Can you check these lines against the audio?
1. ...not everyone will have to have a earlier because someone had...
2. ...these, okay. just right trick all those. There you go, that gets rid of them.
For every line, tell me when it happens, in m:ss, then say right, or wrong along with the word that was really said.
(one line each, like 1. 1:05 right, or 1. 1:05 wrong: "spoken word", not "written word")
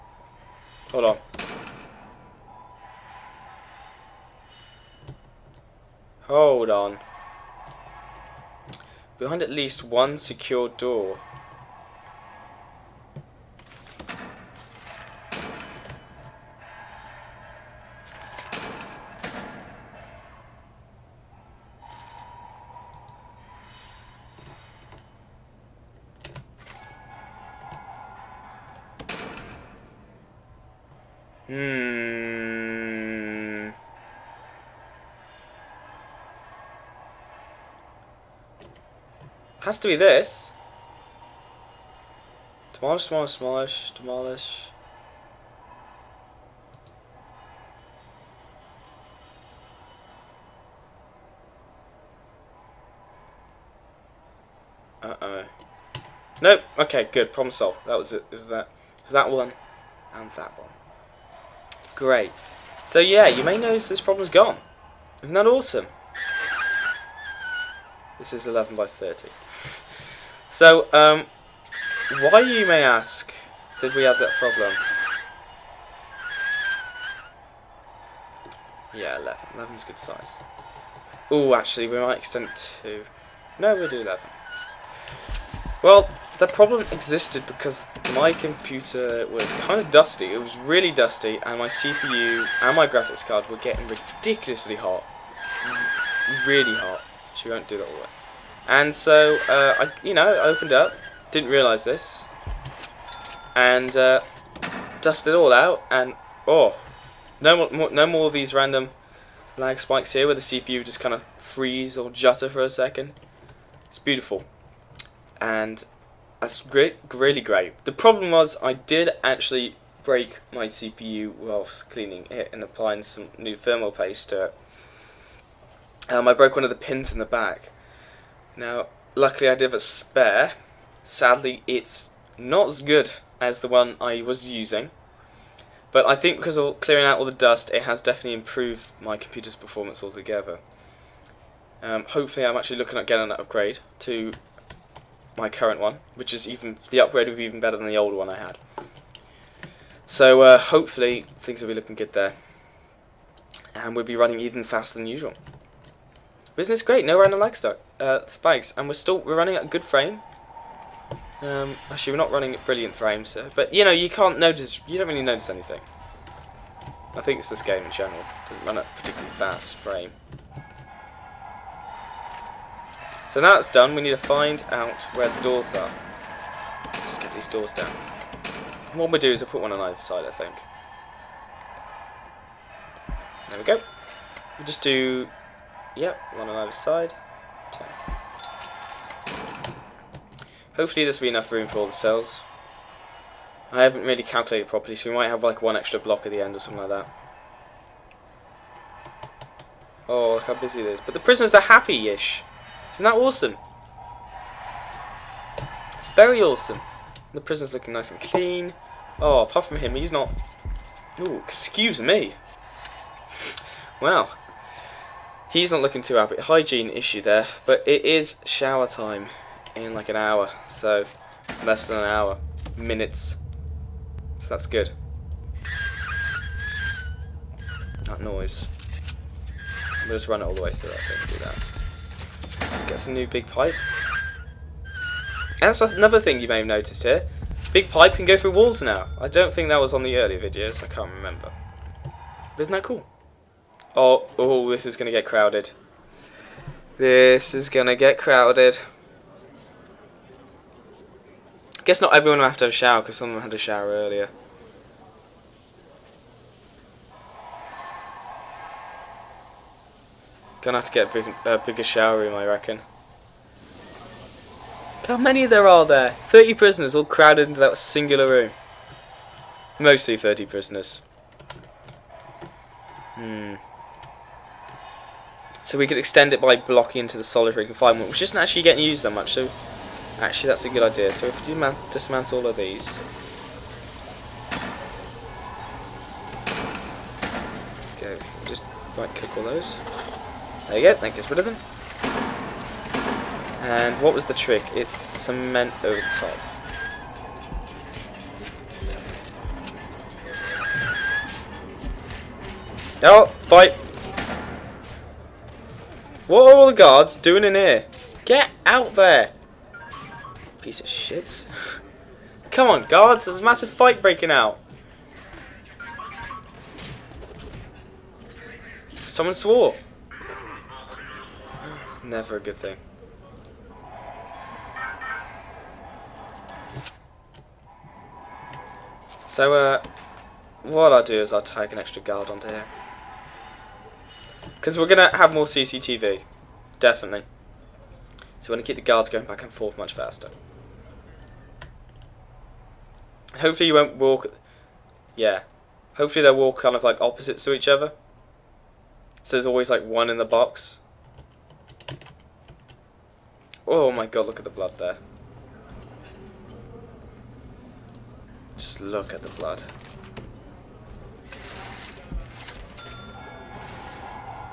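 1. 4:12 wrong: "shower", not "earlier"
2. 4:42 wrong: "click", not "trick".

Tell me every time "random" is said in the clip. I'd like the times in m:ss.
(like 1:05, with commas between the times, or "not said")
1:48, 2:37.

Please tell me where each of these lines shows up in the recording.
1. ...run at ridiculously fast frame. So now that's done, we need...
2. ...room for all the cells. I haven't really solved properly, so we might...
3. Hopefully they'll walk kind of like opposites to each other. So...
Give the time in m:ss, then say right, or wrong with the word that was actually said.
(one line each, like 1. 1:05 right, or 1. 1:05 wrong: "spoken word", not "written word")
1. 2:48 wrong: "particularly", not "ridiculously"
2. 3:11 wrong: "calculated", not "solved"
3. 5:45 right.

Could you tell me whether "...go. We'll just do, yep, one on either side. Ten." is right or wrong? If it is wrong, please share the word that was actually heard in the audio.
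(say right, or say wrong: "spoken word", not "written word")
right.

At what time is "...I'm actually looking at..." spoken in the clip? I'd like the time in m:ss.
2:22.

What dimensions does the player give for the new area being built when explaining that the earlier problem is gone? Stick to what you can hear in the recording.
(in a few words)
11 by 30.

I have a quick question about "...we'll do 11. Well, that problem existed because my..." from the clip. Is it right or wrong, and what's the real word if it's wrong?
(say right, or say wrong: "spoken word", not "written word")
right.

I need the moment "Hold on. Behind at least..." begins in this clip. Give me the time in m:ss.
0:06.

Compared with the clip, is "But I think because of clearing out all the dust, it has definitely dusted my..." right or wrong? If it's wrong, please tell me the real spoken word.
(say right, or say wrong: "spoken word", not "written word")
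wrong: "improved", not "dusted".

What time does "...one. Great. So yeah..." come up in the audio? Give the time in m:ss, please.
1:00.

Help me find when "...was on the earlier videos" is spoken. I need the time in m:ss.
3:59.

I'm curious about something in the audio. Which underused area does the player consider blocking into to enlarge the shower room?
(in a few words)
solitary confinement.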